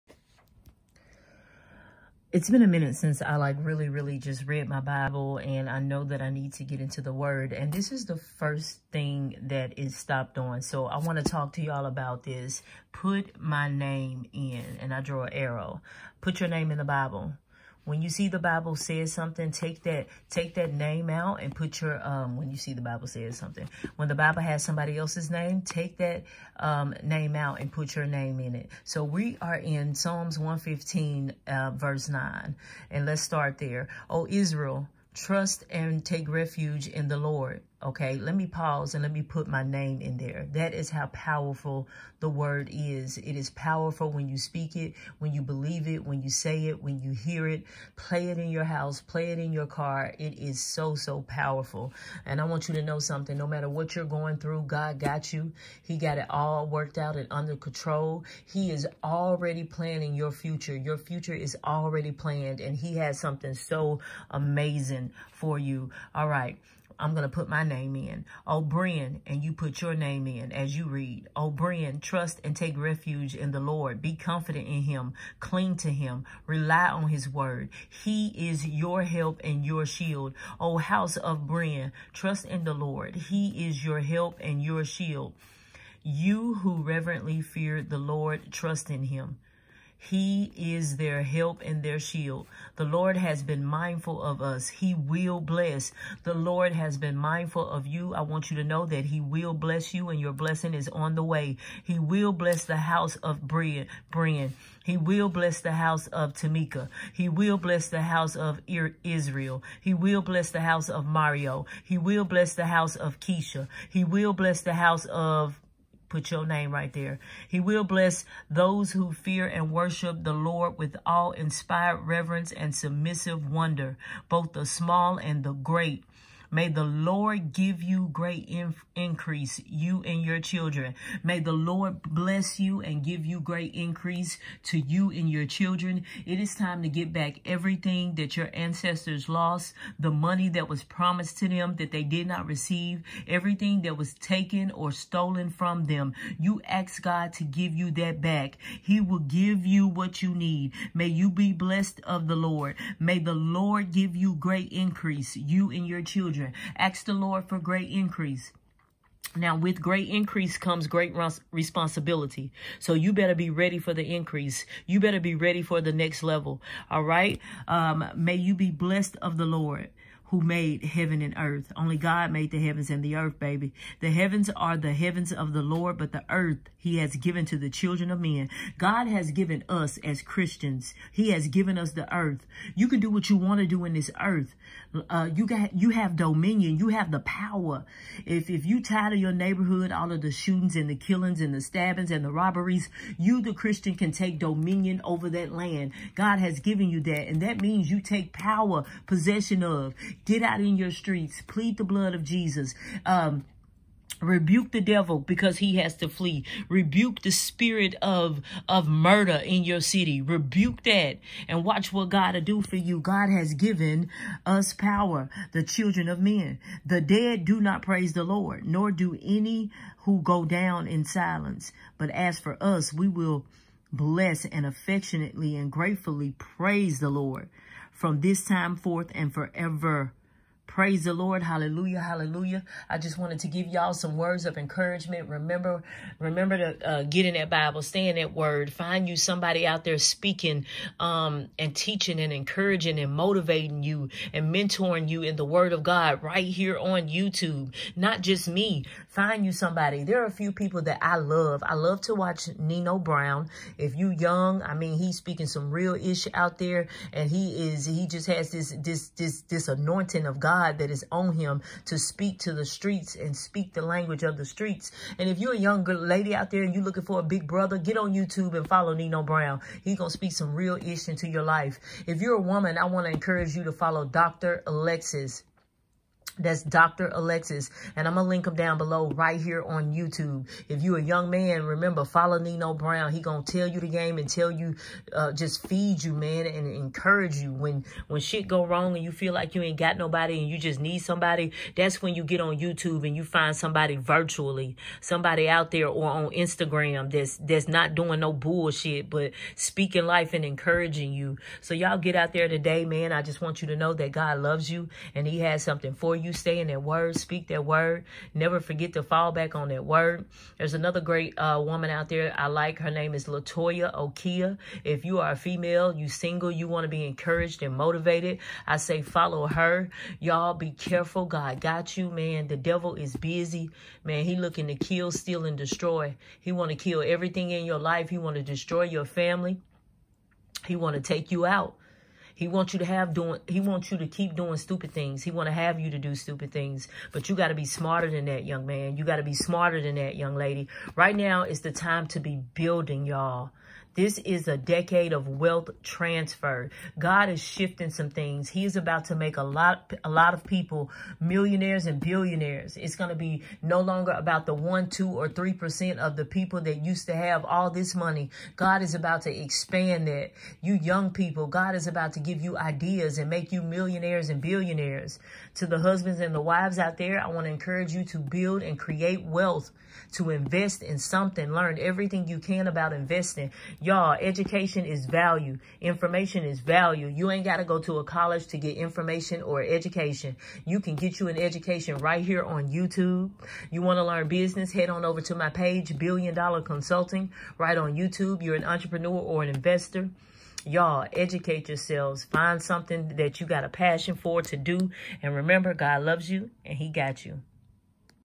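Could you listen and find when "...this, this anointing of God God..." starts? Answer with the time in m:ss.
4:19.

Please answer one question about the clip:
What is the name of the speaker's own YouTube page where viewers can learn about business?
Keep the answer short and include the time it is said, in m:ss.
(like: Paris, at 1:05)
Billion Dollar Consulting, at 6:25.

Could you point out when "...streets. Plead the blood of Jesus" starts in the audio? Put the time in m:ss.
3:20.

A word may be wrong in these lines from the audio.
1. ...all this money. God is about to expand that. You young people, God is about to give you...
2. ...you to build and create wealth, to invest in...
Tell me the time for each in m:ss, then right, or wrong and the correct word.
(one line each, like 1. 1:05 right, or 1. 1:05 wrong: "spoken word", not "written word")
1. 5:57 right
2. 6:07 right.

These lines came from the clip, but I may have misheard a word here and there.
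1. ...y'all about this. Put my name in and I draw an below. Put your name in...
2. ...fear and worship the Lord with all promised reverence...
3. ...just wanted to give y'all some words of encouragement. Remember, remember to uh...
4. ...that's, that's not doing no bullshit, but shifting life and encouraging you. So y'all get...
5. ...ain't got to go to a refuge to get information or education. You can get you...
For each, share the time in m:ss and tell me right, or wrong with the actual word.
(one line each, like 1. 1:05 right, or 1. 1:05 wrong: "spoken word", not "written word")
1. 0:11 wrong: "arrow", not "below"
2. 1:59 wrong: "inspired", not "promised"
3. 3:52 right
4. 4:57 wrong: "speaking", not "shifting"
5. 6:17 wrong: "college", not "refuge".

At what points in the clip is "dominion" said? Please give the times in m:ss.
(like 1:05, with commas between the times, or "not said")
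3:06, 3:14.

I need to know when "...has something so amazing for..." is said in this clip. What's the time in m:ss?
1:02.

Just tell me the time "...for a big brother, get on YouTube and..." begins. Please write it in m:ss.
4:27.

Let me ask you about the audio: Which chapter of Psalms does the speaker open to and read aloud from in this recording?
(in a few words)
115.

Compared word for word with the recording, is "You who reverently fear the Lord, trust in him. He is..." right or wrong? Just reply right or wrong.
right.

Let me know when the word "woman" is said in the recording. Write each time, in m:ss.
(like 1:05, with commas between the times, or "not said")
4:32, 5:11.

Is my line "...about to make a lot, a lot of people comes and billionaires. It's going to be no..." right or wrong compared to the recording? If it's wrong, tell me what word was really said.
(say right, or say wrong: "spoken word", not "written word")
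wrong: "millionaires", not "comes".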